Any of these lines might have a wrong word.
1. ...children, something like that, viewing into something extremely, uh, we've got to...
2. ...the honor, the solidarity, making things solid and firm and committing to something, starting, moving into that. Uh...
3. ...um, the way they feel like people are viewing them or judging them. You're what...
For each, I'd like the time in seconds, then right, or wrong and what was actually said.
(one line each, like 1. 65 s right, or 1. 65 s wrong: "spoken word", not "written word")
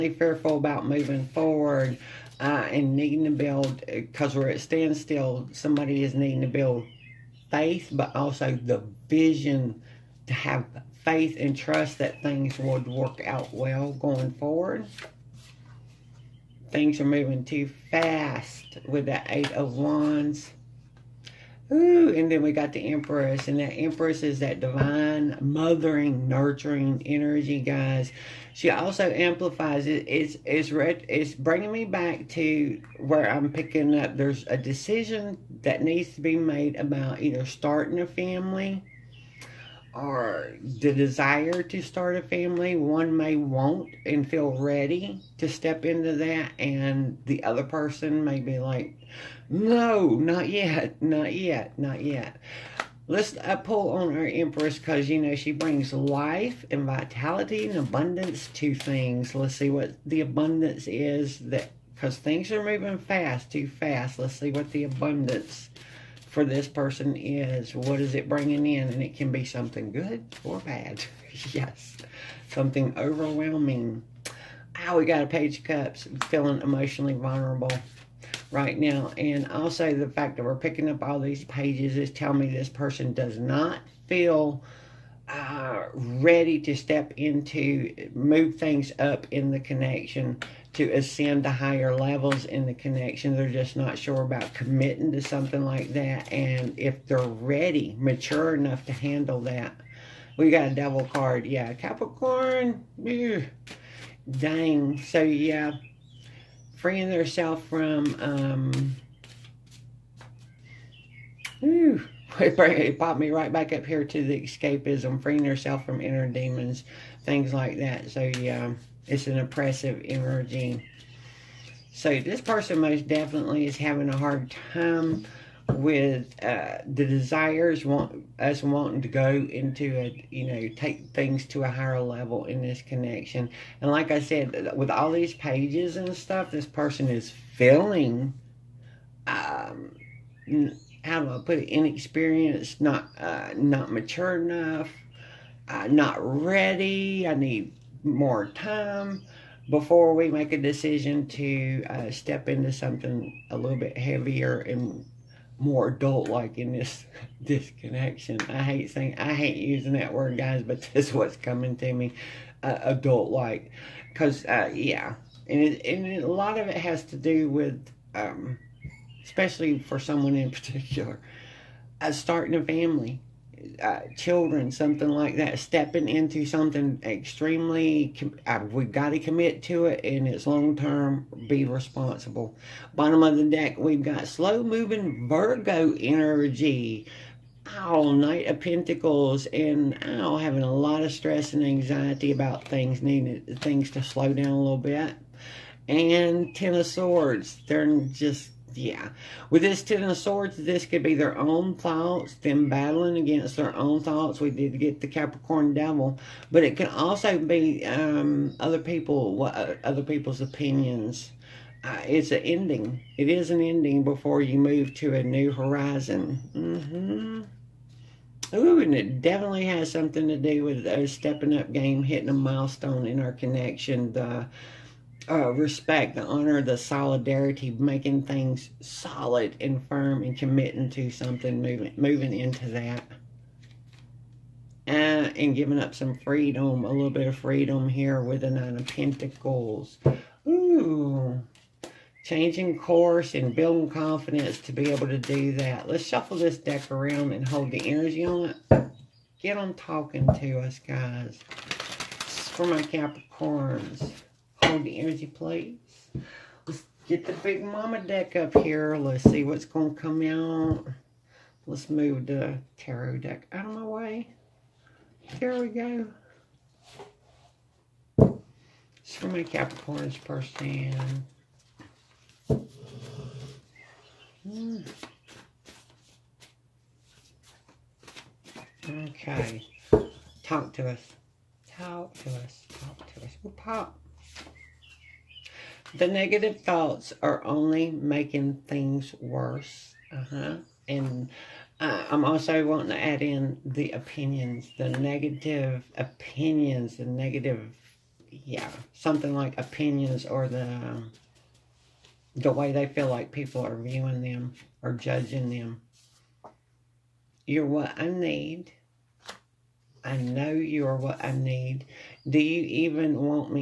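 1. 174 s wrong: "stepping", not "viewing"
2. 226 s wrong: "moving", not "starting"
3. 300 s right.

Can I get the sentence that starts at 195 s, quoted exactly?
And Ten of Swords, they're just yeah.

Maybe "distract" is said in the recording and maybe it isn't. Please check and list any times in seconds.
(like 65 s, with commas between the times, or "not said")
not said.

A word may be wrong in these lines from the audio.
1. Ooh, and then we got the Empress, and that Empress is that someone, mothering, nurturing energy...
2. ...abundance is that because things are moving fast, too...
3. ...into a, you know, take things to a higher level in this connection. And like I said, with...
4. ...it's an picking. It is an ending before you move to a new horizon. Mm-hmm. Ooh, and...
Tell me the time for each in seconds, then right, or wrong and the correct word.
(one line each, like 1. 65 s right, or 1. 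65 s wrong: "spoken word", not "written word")
1. 21 s wrong: "divine", not "someone"
2. 60 s right
3. 129 s right
4. 212 s wrong: "ending", not "picking".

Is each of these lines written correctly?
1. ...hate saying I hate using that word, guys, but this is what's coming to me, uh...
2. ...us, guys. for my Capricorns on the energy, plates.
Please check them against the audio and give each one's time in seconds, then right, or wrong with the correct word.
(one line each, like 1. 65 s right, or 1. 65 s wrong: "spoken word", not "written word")
1. 158 s right
2. 250 s right.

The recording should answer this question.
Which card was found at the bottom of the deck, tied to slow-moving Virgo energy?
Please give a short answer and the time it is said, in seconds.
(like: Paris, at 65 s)
Knight of Pentacles, at 188 s.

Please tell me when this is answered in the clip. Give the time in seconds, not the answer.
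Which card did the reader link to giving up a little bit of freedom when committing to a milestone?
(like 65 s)
238 s.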